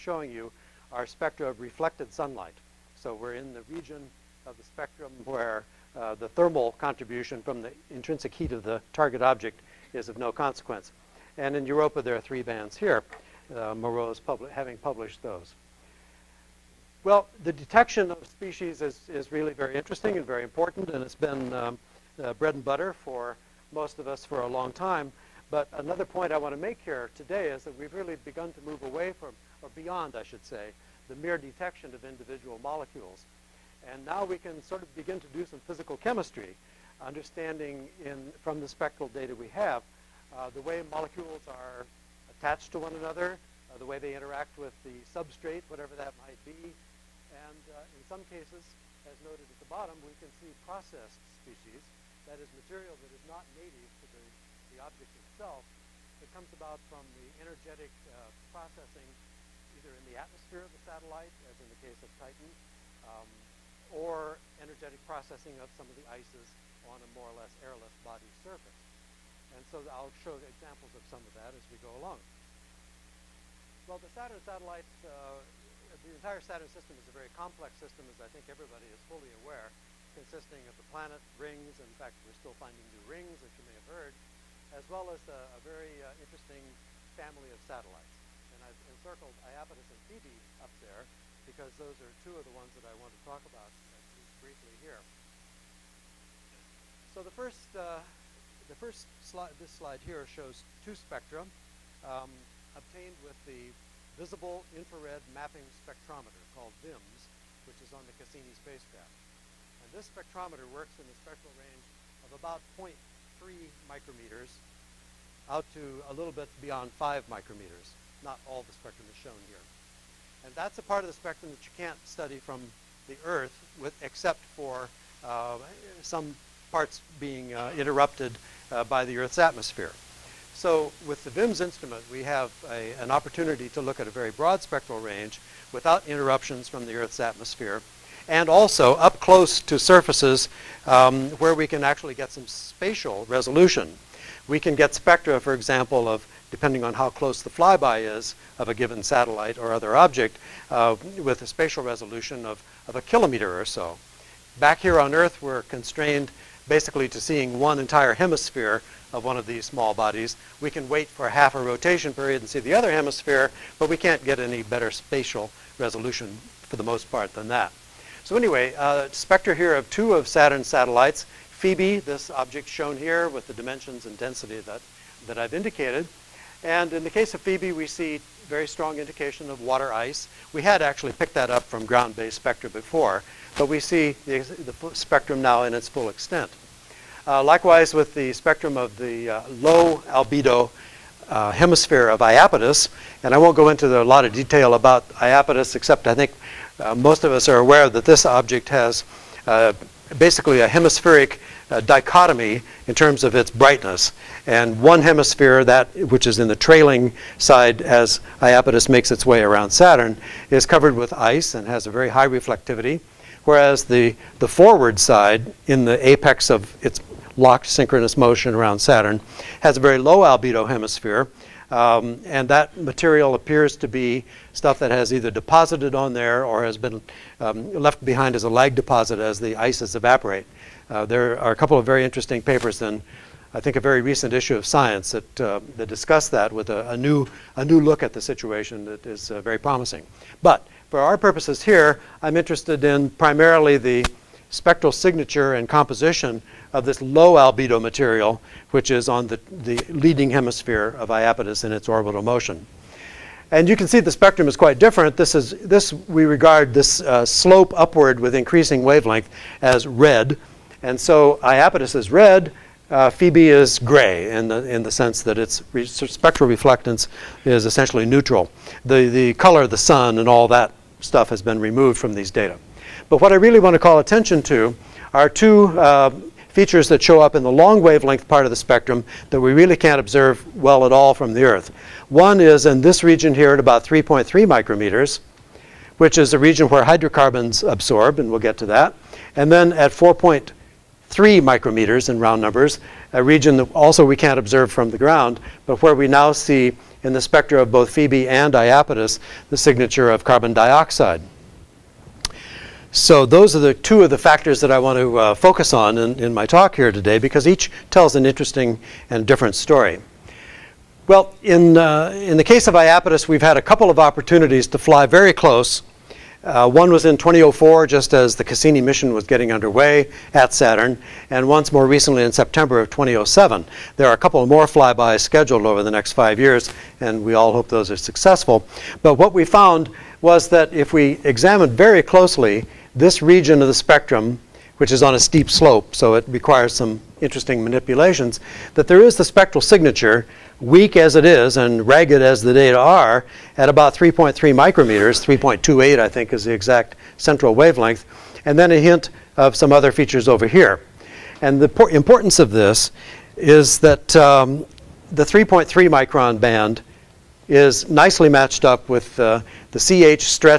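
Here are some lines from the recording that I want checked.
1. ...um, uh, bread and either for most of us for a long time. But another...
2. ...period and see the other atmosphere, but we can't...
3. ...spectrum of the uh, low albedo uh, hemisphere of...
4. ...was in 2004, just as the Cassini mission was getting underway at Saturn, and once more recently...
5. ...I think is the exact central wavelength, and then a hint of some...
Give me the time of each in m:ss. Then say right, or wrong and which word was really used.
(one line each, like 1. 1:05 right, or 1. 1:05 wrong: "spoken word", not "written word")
1. 0:21 wrong: "butter", not "either"
2. 2:42 wrong: "hemisphere", not "atmosphere"
3. 3:08 right
4. 5:16 right
5. 5:45 right.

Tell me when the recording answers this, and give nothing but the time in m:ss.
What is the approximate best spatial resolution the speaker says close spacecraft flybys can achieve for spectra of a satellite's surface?
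2:32.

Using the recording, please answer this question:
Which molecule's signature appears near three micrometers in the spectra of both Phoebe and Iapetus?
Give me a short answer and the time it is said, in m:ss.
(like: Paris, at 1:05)
carbon dioxide, at 5:00.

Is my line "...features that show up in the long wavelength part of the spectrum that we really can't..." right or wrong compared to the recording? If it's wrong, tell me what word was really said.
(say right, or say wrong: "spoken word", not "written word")
right.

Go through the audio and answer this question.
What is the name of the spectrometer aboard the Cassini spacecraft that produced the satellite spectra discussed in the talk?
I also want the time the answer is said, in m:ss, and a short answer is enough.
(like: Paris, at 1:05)
Visible Infrared Mapping Spectrometer, at 1:44.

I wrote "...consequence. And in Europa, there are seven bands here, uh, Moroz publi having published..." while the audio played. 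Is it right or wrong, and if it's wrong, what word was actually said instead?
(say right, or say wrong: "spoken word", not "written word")
wrong: "three", not "seven".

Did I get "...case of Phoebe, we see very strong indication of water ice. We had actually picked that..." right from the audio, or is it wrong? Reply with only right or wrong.
right.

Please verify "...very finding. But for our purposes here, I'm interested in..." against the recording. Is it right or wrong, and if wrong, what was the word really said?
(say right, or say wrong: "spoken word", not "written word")
wrong: "promising", not "finding".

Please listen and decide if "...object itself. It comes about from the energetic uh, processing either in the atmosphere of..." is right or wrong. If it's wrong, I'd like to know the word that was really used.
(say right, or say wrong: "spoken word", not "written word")
right.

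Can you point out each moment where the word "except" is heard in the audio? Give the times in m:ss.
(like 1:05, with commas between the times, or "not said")
2:04, 3:15.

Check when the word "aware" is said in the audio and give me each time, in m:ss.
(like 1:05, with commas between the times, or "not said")
1:19, 3:17.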